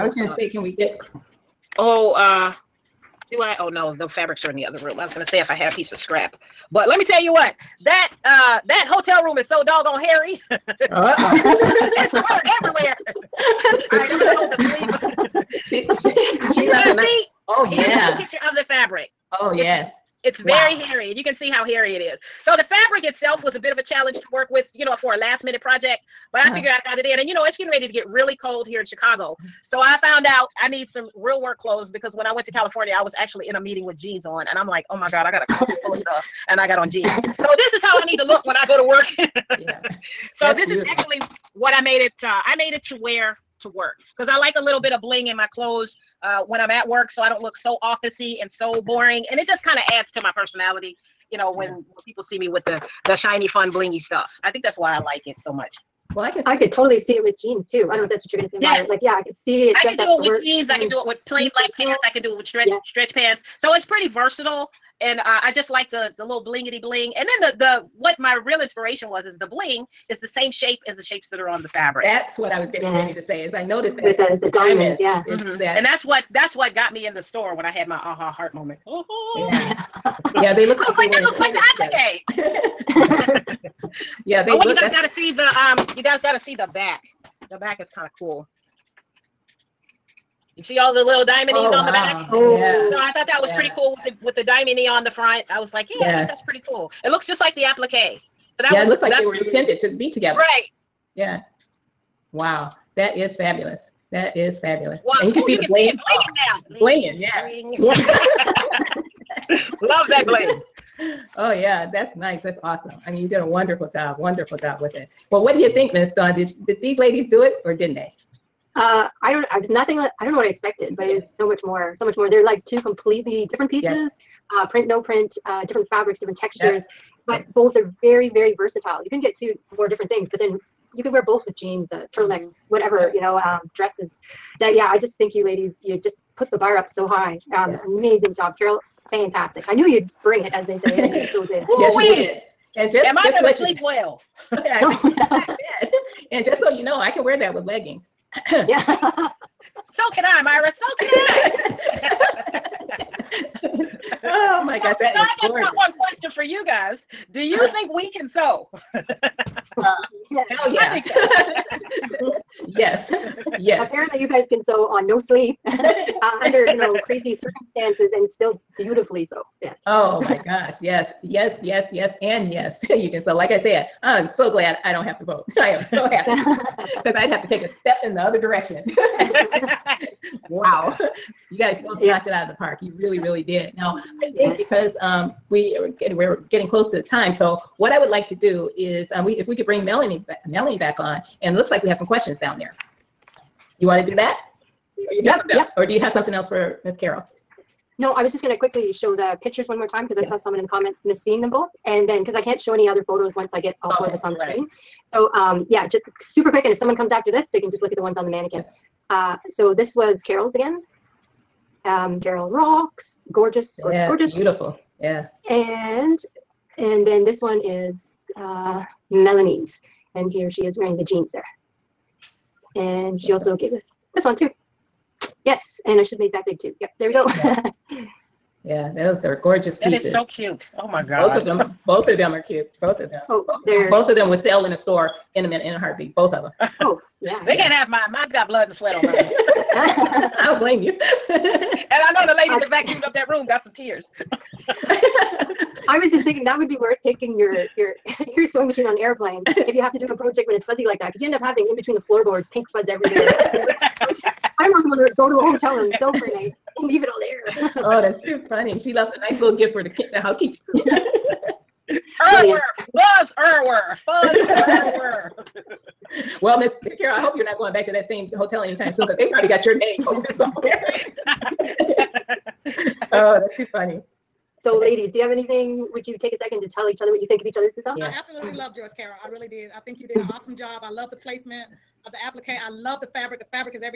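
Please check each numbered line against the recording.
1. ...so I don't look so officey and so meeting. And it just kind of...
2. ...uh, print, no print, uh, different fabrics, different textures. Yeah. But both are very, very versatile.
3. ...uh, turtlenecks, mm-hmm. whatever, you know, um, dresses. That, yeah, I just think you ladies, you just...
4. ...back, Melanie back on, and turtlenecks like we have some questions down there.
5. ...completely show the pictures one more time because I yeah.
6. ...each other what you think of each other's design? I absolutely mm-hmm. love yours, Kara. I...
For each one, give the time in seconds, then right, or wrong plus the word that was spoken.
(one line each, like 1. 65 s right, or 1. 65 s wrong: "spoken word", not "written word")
1. 47 s wrong: "boring", not "meeting"
2. 124 s right
3. 131 s right
4. 190 s wrong: "looks", not "turtlenecks"
5. 198 s wrong: "quickly", not "completely"
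6. 276 s right.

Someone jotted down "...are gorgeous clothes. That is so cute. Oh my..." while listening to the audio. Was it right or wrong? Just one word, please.
wrong.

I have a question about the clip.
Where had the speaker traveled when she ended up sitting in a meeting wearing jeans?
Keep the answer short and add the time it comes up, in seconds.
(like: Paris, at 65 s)
California, at 32 s.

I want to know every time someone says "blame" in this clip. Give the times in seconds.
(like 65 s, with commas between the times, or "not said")
240 s.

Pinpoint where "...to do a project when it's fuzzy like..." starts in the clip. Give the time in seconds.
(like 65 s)
249 s.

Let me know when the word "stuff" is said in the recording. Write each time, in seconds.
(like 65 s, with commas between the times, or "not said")
35 s, 53 s.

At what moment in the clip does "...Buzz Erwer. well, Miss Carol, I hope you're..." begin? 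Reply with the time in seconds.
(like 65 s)
263 s.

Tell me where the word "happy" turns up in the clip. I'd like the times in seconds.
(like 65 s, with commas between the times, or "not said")
176 s.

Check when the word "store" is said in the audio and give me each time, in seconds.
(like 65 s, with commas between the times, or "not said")
77 s, 234 s.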